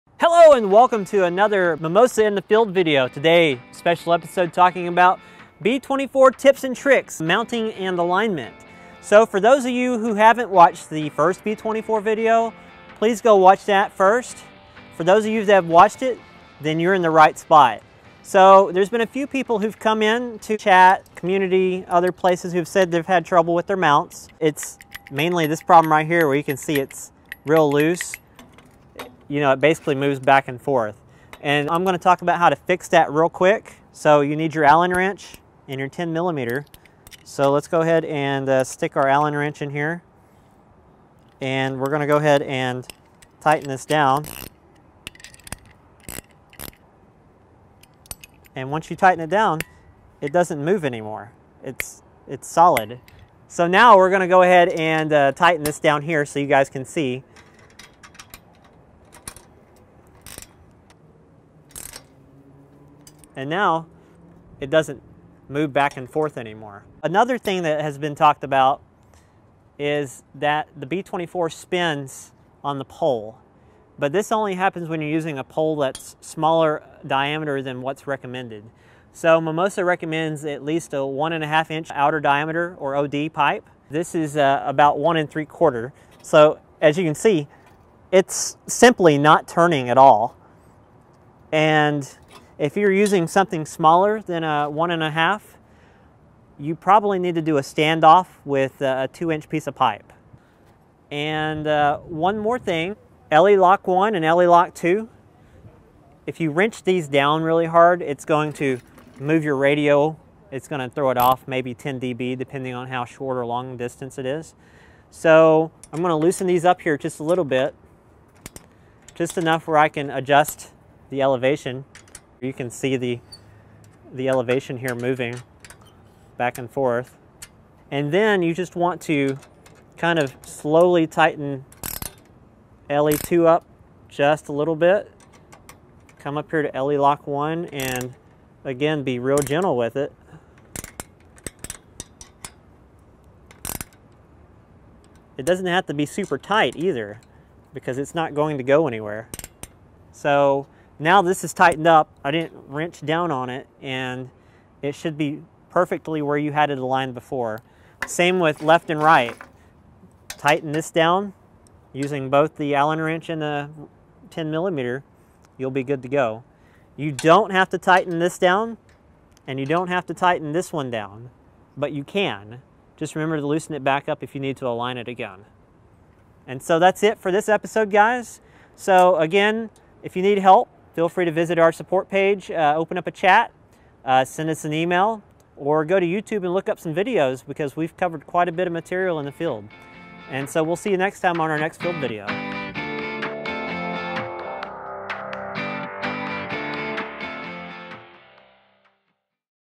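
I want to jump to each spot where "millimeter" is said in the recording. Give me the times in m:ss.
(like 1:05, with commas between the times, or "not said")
0:36, 2:44.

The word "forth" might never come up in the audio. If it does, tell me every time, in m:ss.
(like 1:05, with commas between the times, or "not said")
0:30, 1:06, 2:06.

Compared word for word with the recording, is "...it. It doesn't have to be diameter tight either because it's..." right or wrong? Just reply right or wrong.
wrong.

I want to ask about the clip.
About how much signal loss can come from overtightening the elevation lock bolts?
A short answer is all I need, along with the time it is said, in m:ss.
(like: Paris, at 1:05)
10 dB, at 1:51.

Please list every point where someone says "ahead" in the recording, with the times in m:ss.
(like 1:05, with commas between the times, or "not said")
0:37, 0:42, 0:54.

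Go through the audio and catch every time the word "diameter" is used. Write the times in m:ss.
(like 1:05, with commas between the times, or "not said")
1:17, 1:22.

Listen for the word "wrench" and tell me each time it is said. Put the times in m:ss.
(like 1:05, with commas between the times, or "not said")
0:34, 0:39, 1:46, 2:32, 2:43.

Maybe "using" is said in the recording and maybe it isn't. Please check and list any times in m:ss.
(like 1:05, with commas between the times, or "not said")
1:15, 1:32, 2:41.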